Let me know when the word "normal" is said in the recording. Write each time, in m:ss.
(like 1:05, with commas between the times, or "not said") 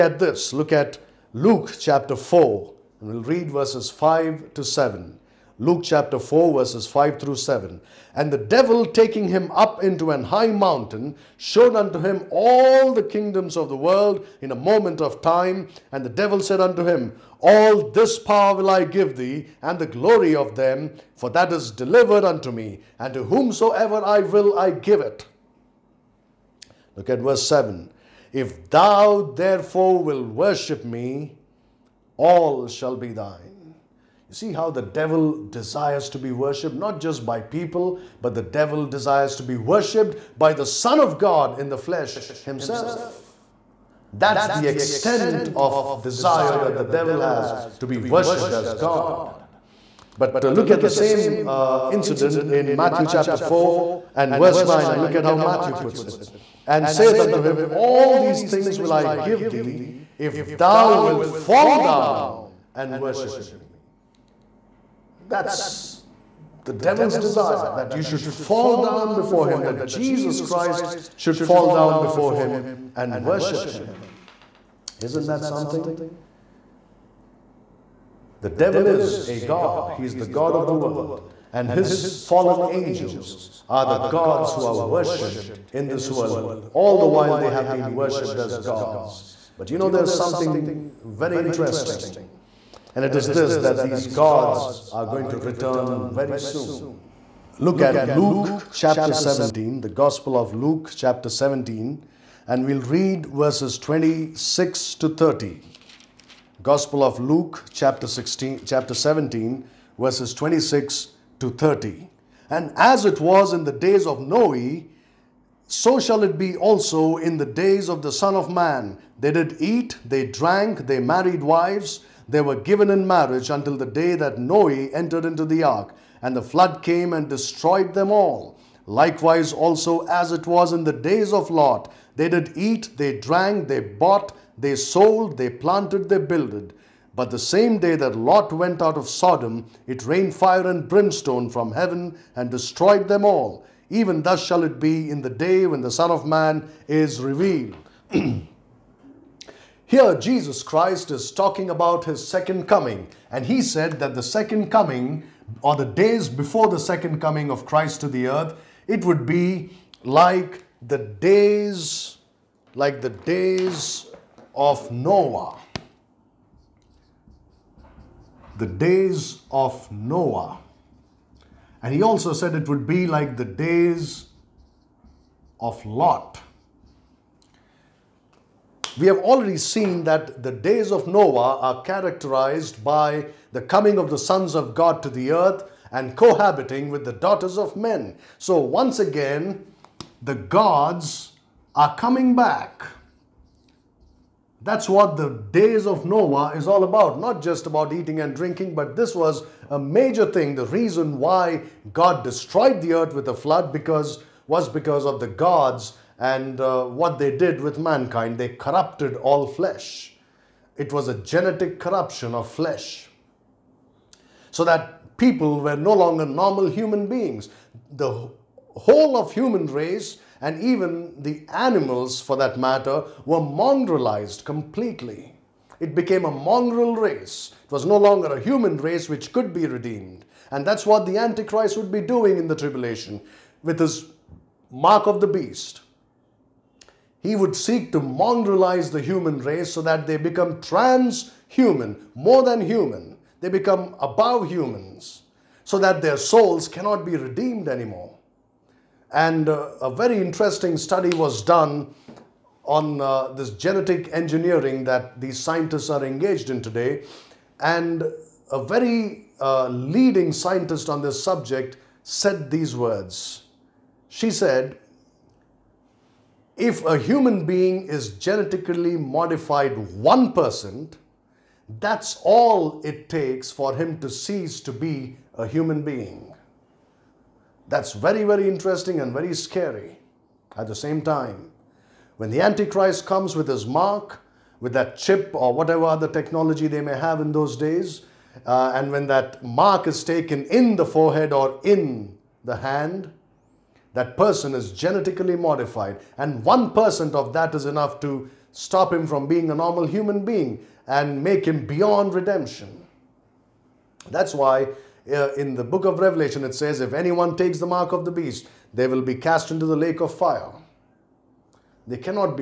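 3:36, 4:59.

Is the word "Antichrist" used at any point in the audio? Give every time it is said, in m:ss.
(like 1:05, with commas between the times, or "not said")
3:51, 4:42.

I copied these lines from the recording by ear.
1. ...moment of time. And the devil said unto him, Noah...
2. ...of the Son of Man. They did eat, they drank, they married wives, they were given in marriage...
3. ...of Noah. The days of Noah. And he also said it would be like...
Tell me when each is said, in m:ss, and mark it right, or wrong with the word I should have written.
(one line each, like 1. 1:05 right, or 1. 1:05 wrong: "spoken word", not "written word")
1. 0:14 wrong: "All", not "Noah"
2. 1:57 right
3. 2:44 right.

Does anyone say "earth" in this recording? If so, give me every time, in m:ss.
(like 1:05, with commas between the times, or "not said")
2:38, 3:05, 3:22.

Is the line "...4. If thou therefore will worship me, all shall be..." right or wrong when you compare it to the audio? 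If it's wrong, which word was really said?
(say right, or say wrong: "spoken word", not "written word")
wrong: "7", not "4".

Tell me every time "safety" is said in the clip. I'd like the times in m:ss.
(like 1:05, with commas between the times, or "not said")
not said.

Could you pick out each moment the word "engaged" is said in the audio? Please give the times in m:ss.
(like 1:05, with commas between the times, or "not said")
4:16.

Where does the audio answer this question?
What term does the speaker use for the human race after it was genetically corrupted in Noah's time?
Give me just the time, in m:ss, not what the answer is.
3:46.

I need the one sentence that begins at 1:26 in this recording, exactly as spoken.
All the while they have been worshipped as gods.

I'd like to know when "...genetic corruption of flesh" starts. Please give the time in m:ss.
3:31.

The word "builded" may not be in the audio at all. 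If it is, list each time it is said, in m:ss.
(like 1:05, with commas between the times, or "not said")
2:16.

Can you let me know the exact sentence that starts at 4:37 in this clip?
That's very, very interesting and very scary.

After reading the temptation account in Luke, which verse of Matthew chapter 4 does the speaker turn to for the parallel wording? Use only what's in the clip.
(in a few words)
9.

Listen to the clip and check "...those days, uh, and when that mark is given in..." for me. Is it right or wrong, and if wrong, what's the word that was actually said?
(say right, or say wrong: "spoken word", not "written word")
wrong: "taken", not "given".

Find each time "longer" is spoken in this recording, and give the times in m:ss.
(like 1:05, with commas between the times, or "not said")
3:35, 3:47.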